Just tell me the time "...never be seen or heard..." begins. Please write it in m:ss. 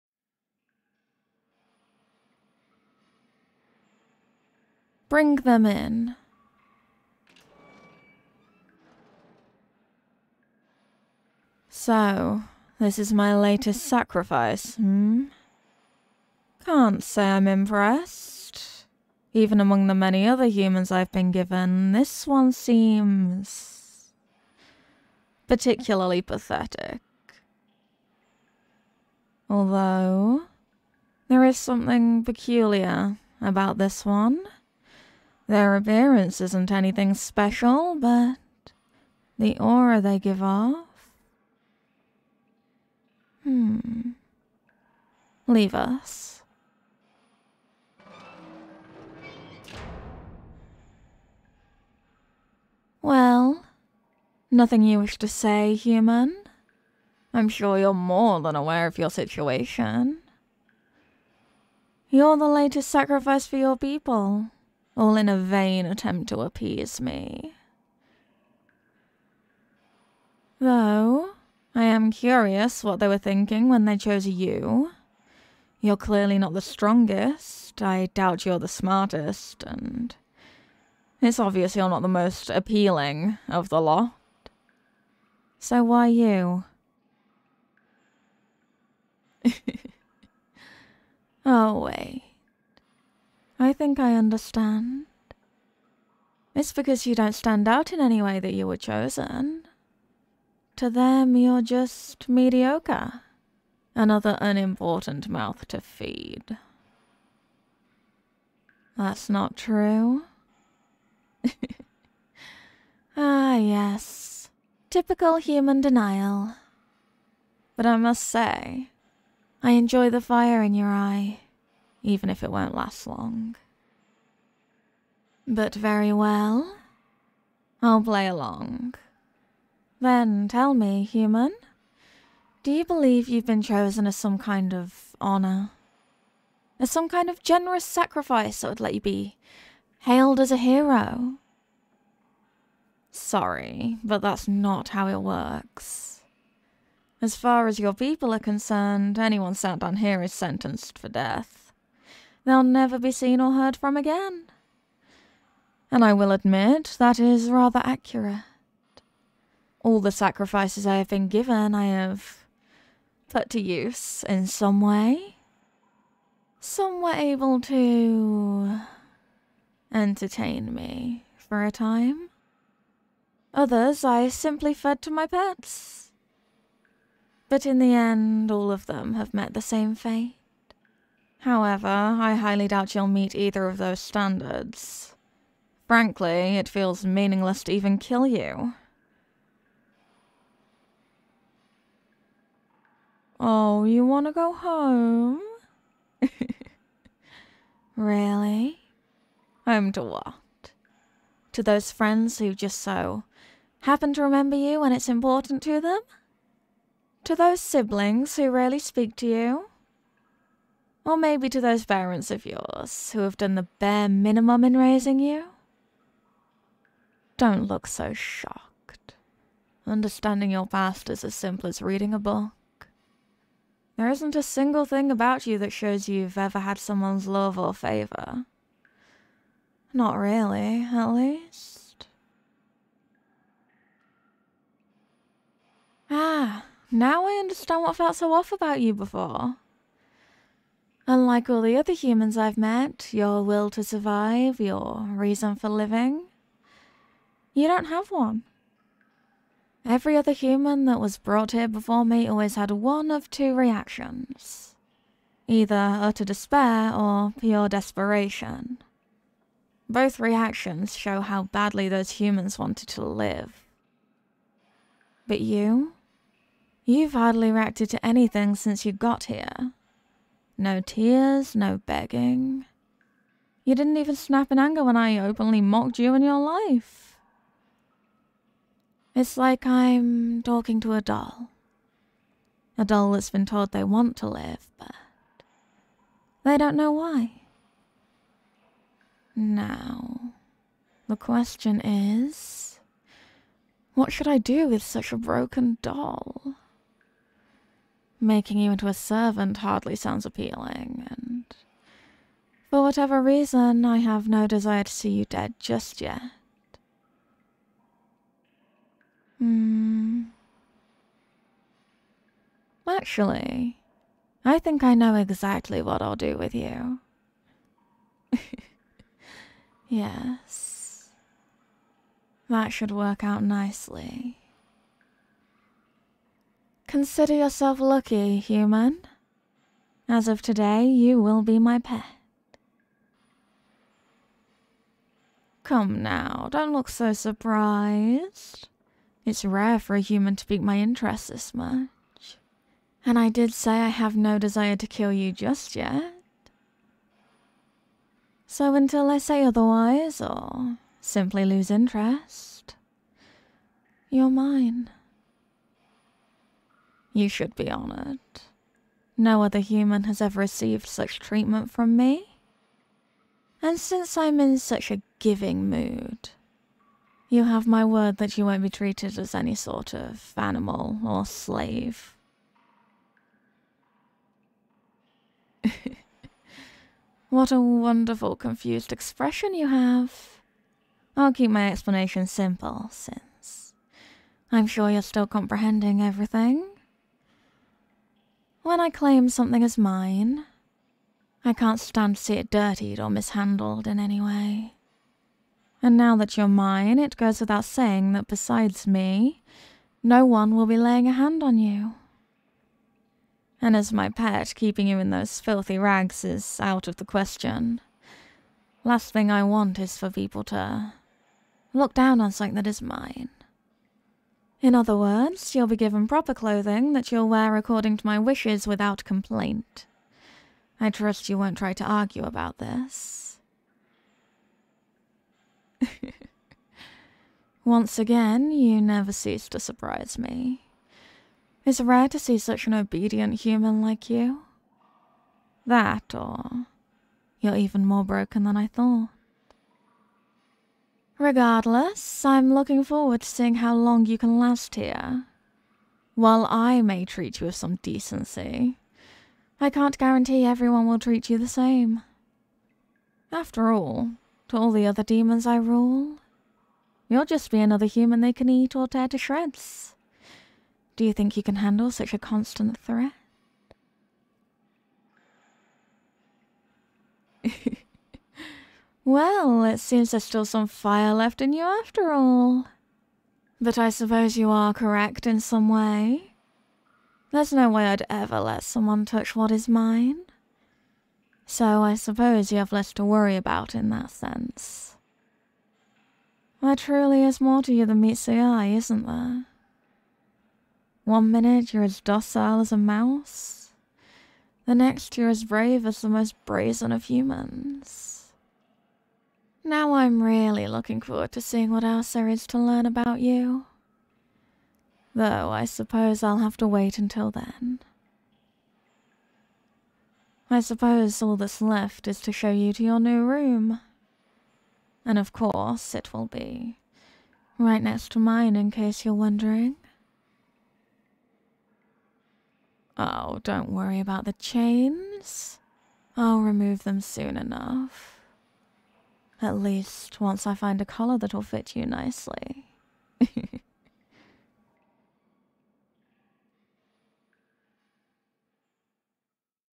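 2:32.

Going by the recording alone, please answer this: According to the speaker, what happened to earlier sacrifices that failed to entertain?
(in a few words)
Fed to my pets.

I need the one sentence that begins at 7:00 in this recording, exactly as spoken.
I trust you won't try to argue about this.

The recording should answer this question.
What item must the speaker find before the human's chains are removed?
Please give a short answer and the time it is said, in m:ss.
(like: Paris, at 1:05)
A collar, at 8:50.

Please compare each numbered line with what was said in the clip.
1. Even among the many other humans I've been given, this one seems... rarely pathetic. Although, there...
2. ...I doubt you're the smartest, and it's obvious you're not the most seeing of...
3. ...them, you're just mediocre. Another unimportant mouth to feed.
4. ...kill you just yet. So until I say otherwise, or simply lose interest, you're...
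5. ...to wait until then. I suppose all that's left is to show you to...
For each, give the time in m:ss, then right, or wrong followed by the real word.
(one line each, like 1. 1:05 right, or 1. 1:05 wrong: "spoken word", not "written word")
1. 0:19 wrong: "particularly", not "rarely"
2. 1:17 wrong: "appealing", not "seeing"
3. 1:40 right
4. 5:44 right
5. 8:26 right.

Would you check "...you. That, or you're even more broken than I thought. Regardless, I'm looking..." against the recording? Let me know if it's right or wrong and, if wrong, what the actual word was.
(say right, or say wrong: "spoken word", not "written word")
right.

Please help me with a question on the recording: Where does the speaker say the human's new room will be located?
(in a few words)
Right next to mine.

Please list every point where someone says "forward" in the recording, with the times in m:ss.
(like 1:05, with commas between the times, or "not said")
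7:22, 8:21.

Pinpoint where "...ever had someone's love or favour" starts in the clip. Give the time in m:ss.
3:46.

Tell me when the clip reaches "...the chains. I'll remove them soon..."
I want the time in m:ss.
8:44.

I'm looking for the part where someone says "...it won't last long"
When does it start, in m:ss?
2:02.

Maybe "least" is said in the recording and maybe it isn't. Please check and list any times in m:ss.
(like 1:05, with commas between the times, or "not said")
3:51, 8:49.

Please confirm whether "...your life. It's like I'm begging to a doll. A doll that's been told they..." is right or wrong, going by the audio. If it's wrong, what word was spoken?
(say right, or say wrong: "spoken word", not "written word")
wrong: "talking", not "begging".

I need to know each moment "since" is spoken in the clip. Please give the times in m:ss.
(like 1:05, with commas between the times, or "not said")
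4:28, 6:03, 6:22.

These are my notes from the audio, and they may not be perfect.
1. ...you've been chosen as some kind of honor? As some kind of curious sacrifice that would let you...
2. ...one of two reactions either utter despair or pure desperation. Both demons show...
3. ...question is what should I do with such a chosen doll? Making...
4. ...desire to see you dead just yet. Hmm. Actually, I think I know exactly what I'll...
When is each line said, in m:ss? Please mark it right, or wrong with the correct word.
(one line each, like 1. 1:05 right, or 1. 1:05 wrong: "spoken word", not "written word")
1. 2:13 wrong: "generous", not "curious"
2. 4:12 wrong: "reactions", not "demons"
3. 4:51 wrong: "broken", not "chosen"
4. 5:04 right.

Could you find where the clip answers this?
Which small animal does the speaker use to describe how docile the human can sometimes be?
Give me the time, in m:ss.
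8:12.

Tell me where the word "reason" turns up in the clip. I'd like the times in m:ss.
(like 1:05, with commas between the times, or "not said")
4:05, 5:03.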